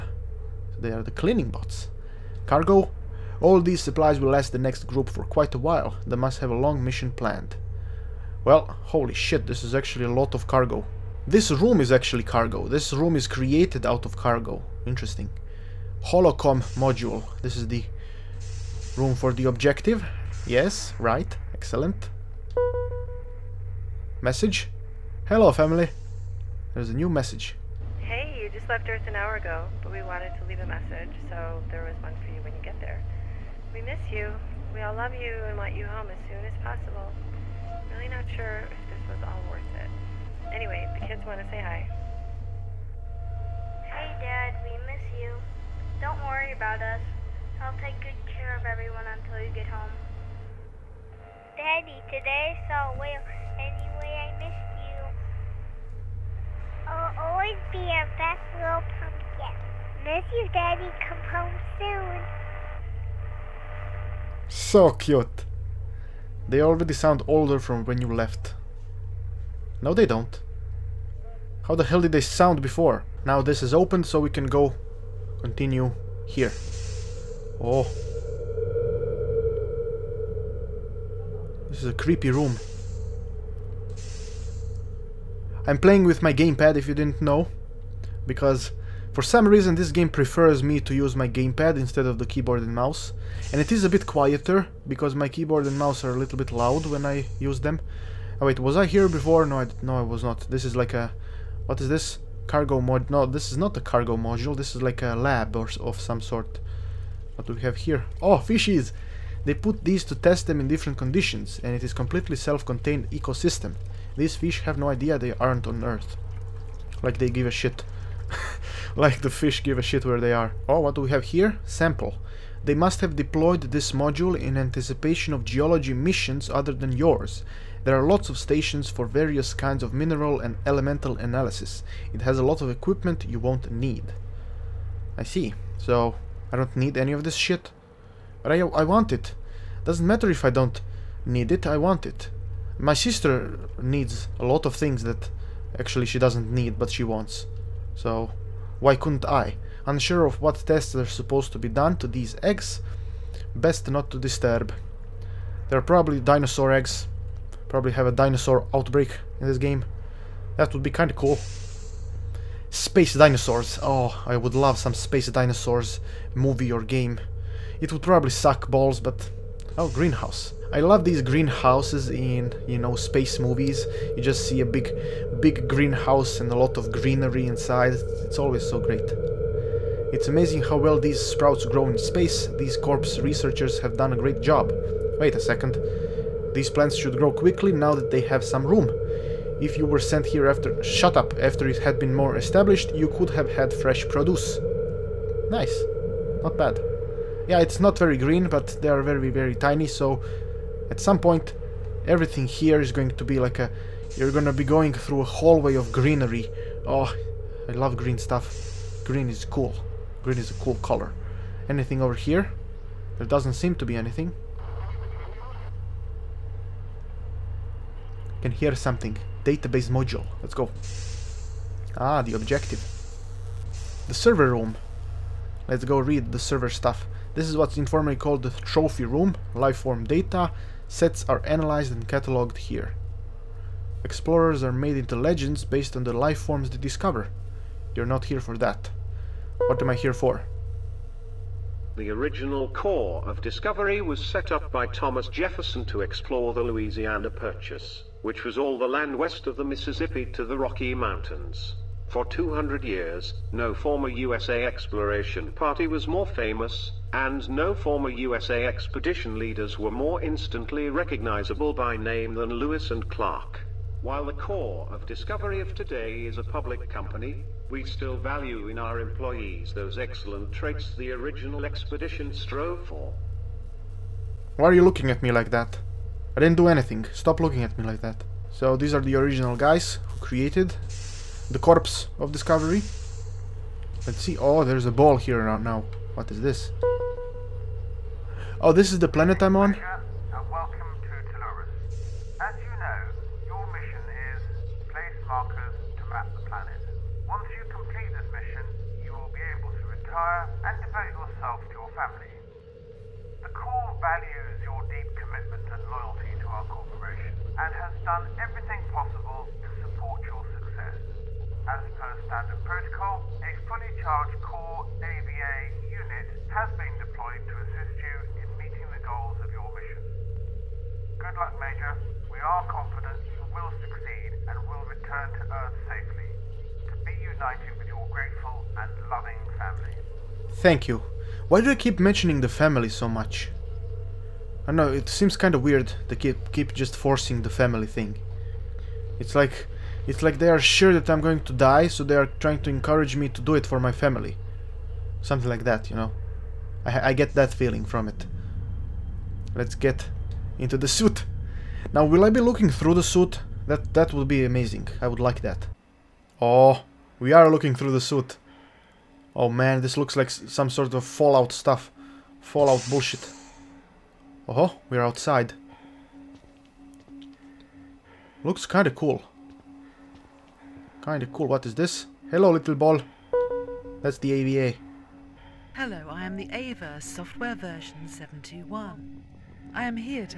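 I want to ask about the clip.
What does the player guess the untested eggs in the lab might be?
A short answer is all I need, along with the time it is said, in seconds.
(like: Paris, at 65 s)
dinosaur eggs, at 156 s.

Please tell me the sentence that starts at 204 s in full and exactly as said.
You're gonna be going through a hallway of greenery.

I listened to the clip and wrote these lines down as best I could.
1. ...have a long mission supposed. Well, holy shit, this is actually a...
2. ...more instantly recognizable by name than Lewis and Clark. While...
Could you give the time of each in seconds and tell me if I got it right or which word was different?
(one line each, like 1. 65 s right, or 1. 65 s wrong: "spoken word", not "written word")
1. 6 s wrong: "planned", not "supposed"
2. 259 s right.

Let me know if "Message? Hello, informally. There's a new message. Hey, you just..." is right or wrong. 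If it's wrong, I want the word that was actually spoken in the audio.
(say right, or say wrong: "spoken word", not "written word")
wrong: "family", not "informally".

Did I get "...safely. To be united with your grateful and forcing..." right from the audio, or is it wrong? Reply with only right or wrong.
wrong.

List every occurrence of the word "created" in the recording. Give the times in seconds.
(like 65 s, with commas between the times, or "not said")
13 s, 280 s.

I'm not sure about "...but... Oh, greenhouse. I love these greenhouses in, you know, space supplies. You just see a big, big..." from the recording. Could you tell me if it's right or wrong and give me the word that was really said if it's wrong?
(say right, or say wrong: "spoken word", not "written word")
wrong: "movies", not "supplies".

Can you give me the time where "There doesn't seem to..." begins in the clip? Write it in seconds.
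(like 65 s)
213 s.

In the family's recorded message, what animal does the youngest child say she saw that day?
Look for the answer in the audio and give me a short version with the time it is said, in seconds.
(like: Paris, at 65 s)
whale, at 52 s.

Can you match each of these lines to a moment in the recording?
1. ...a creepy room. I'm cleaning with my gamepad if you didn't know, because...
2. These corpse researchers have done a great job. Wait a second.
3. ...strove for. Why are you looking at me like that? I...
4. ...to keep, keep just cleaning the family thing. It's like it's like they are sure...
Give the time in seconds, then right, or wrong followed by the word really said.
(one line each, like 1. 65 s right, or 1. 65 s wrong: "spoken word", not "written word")
1. 81 s wrong: "playing", not "cleaning"
2. 182 s right
3. 272 s right
4. 336 s wrong: "forcing", not "cleaning".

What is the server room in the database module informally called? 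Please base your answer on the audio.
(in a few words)
the trophy room.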